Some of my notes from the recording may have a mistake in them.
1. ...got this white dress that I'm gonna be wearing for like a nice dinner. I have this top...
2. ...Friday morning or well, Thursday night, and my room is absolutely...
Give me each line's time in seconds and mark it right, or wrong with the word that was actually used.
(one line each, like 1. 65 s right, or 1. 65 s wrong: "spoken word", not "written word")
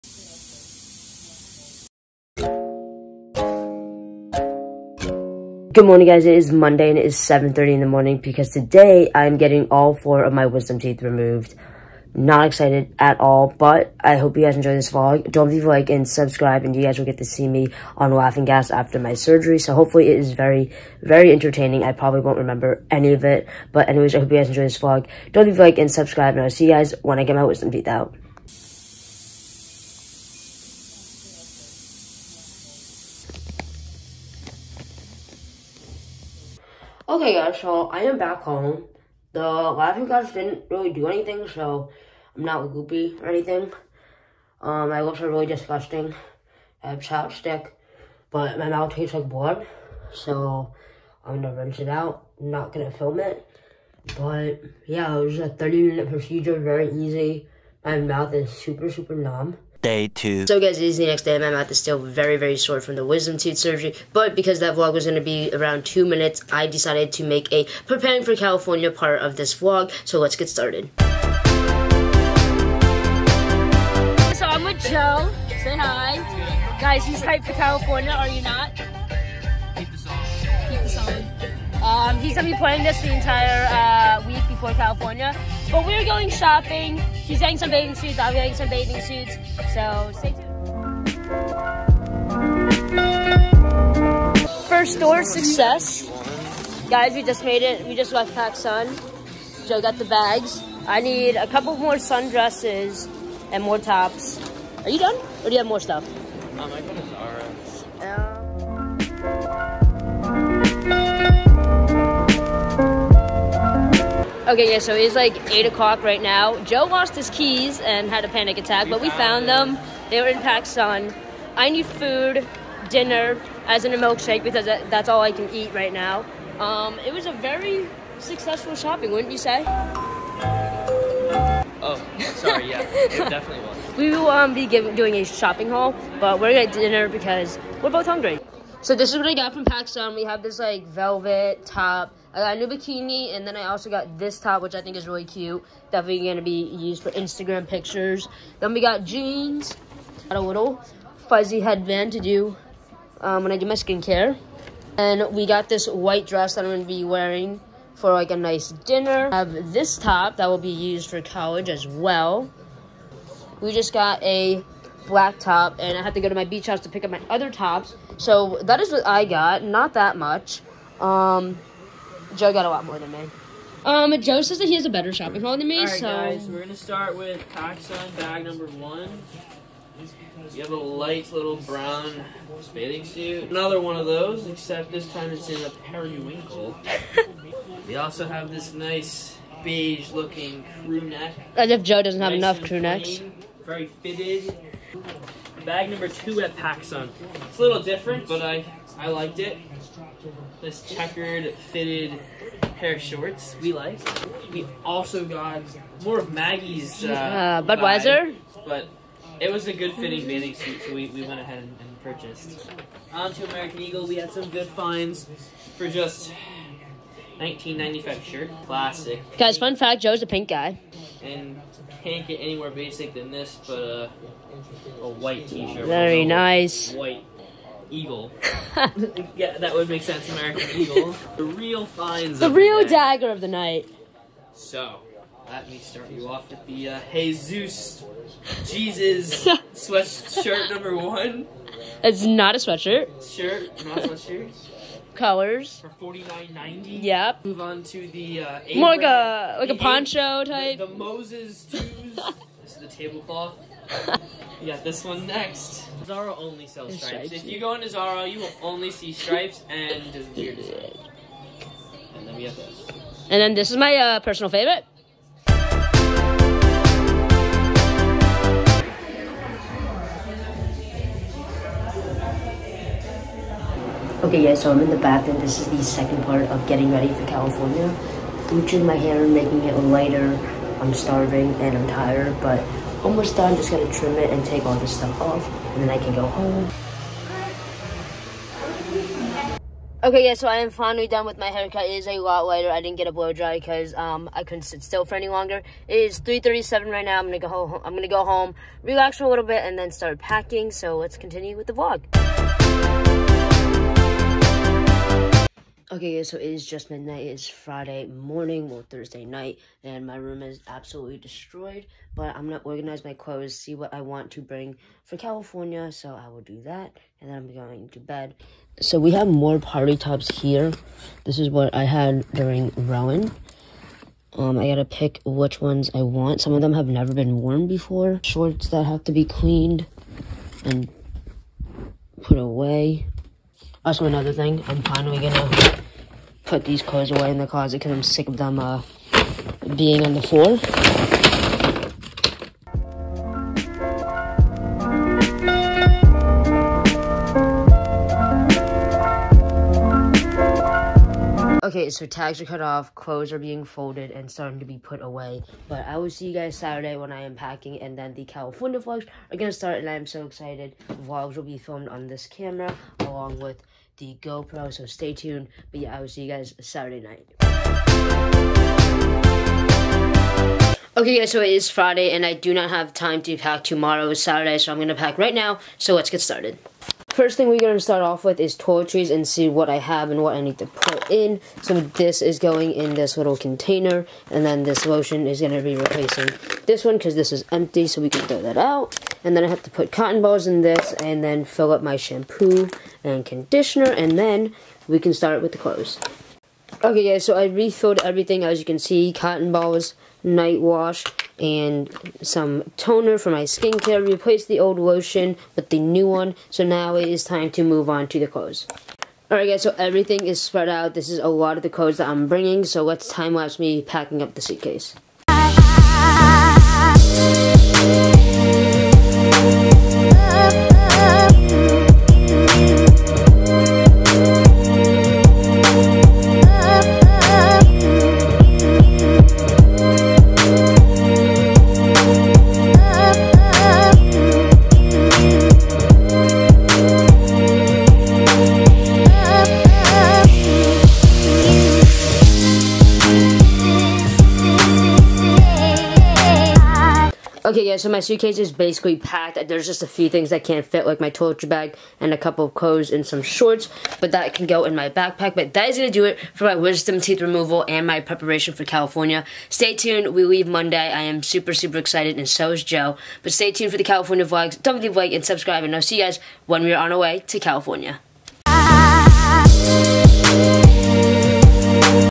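1. 155 s right
2. 307 s right.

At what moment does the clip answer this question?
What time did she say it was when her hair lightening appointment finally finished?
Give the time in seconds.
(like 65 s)
296 s.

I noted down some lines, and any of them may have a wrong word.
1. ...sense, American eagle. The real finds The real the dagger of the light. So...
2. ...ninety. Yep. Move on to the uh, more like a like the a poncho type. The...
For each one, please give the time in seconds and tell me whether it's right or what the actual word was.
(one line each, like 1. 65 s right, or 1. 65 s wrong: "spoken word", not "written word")
1. 230 s wrong: "night", not "light"
2. 246 s right.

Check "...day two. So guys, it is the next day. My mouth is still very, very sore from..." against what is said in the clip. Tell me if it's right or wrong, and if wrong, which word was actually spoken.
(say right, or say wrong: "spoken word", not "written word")
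right.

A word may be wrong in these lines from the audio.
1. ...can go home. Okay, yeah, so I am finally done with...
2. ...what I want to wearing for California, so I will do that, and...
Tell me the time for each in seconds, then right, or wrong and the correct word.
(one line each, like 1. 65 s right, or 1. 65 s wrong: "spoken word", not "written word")
1. 285 s right
2. 313 s wrong: "bring", not "wearing".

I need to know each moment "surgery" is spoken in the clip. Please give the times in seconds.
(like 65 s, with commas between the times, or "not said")
19 s, 63 s.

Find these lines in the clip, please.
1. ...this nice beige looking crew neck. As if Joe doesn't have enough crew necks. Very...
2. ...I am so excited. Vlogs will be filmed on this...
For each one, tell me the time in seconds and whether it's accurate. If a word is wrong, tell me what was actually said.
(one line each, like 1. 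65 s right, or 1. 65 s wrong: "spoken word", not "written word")
1. 188 s right
2. 359 s right.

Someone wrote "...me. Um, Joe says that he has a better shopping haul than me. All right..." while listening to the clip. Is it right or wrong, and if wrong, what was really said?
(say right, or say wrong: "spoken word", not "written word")
right.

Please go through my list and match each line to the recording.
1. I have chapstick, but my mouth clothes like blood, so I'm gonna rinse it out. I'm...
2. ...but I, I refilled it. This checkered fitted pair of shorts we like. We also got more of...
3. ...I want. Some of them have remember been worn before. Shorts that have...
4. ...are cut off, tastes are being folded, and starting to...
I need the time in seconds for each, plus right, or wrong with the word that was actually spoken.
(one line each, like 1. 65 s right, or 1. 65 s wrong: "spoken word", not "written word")
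1. 46 s wrong: "tastes", not "clothes"
2. 198 s wrong: "liked", not "refilled"
3. 325 s wrong: "never", not "remember"
4. 352 s wrong: "clothes", not "tastes".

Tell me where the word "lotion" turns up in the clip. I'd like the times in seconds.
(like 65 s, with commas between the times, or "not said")
384 s, 404 s.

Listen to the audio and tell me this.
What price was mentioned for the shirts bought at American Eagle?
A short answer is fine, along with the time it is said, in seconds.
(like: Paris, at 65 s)
$19.95, at 217 s.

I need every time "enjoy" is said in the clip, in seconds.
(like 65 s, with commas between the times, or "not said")
14 s, 24 s.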